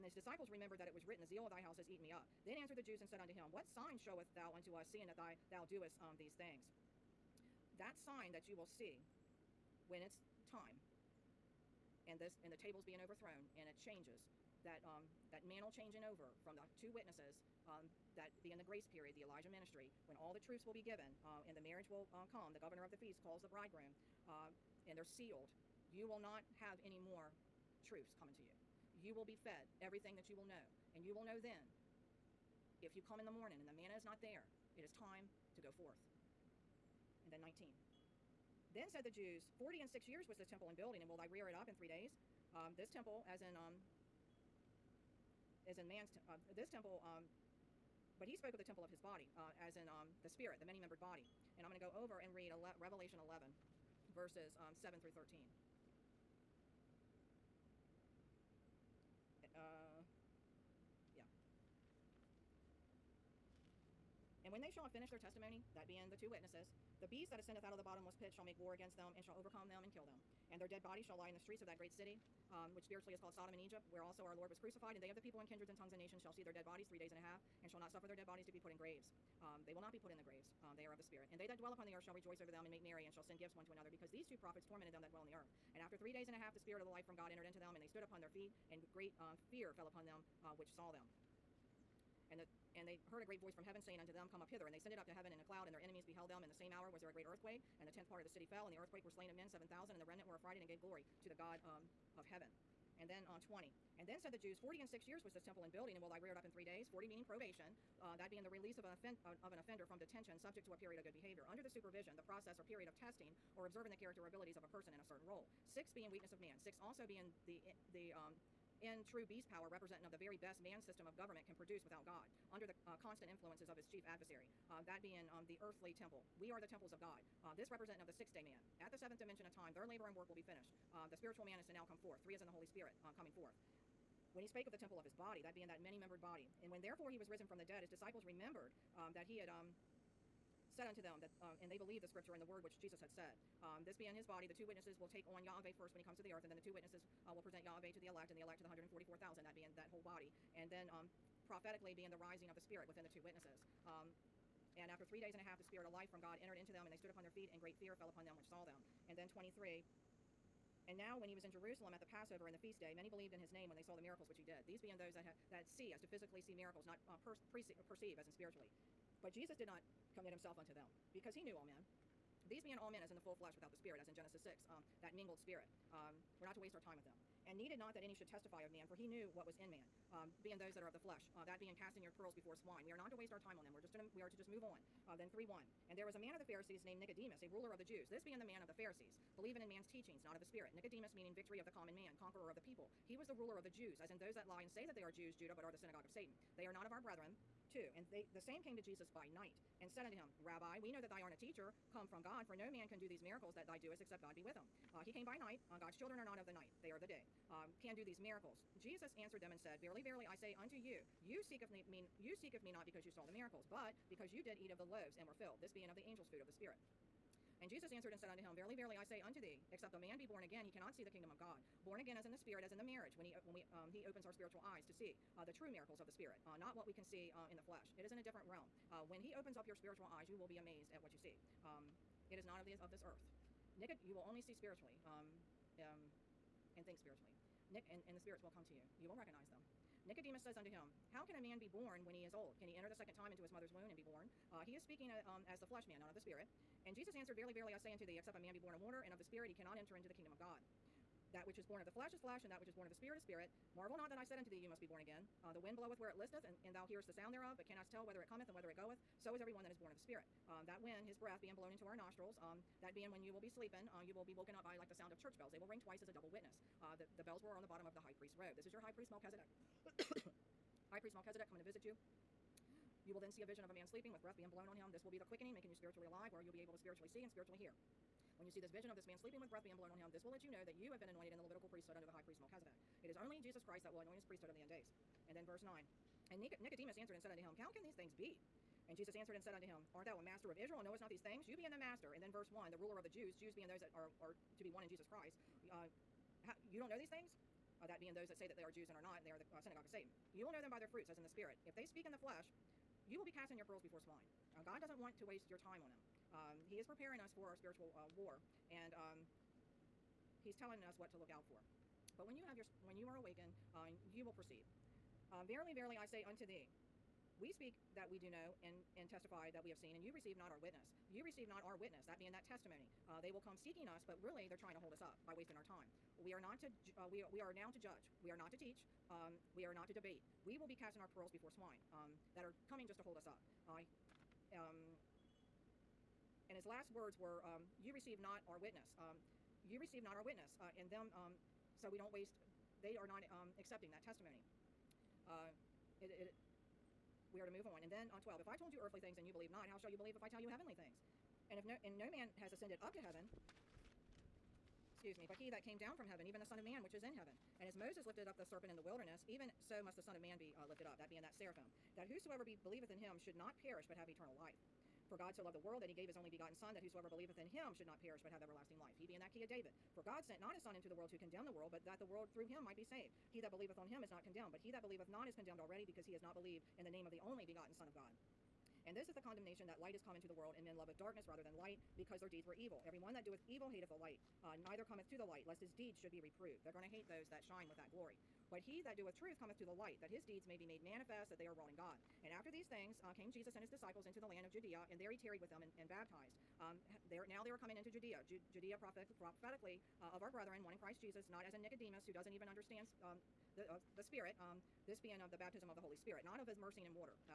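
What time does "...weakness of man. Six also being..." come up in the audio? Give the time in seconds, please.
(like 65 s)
116 s.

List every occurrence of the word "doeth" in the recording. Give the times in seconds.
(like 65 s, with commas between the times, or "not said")
383 s, 388 s.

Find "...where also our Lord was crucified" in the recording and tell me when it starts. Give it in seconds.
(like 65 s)
73 s.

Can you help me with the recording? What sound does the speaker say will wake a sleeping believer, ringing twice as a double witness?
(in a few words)
church bells.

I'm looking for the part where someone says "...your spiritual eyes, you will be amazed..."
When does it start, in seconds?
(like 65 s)
229 s.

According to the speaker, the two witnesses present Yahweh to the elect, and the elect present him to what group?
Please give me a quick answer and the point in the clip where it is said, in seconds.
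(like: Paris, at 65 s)
144,000, at 148 s.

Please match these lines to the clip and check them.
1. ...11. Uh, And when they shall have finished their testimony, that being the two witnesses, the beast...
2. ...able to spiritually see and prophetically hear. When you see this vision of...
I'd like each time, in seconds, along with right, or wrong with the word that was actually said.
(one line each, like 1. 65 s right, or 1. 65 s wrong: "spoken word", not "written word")
1. 55 s wrong: "13", not "11"
2. 276 s wrong: "spiritually", not "prophetically".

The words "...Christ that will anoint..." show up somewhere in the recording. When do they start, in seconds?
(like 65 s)
283 s.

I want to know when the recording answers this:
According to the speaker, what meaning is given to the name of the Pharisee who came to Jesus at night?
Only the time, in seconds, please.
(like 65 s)
191 s.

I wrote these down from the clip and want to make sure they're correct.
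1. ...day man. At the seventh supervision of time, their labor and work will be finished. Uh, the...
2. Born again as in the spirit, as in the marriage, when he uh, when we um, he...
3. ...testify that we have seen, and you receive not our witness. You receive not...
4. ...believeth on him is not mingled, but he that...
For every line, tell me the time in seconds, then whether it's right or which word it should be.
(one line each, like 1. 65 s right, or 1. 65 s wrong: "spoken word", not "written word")
1. 128 s wrong: "dimension", not "supervision"
2. 221 s right
3. 319 s right
4. 373 s wrong: "condemned", not "mingled".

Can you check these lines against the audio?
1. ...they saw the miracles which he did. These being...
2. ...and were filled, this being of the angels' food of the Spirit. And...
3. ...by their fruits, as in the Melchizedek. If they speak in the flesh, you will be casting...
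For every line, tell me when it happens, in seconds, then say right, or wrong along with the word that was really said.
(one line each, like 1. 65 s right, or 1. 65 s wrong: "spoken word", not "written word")
1. 163 s right
2. 215 s right
3. 300 s wrong: "Spirit", not "Melchizedek".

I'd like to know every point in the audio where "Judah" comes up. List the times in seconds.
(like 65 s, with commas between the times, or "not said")
195 s.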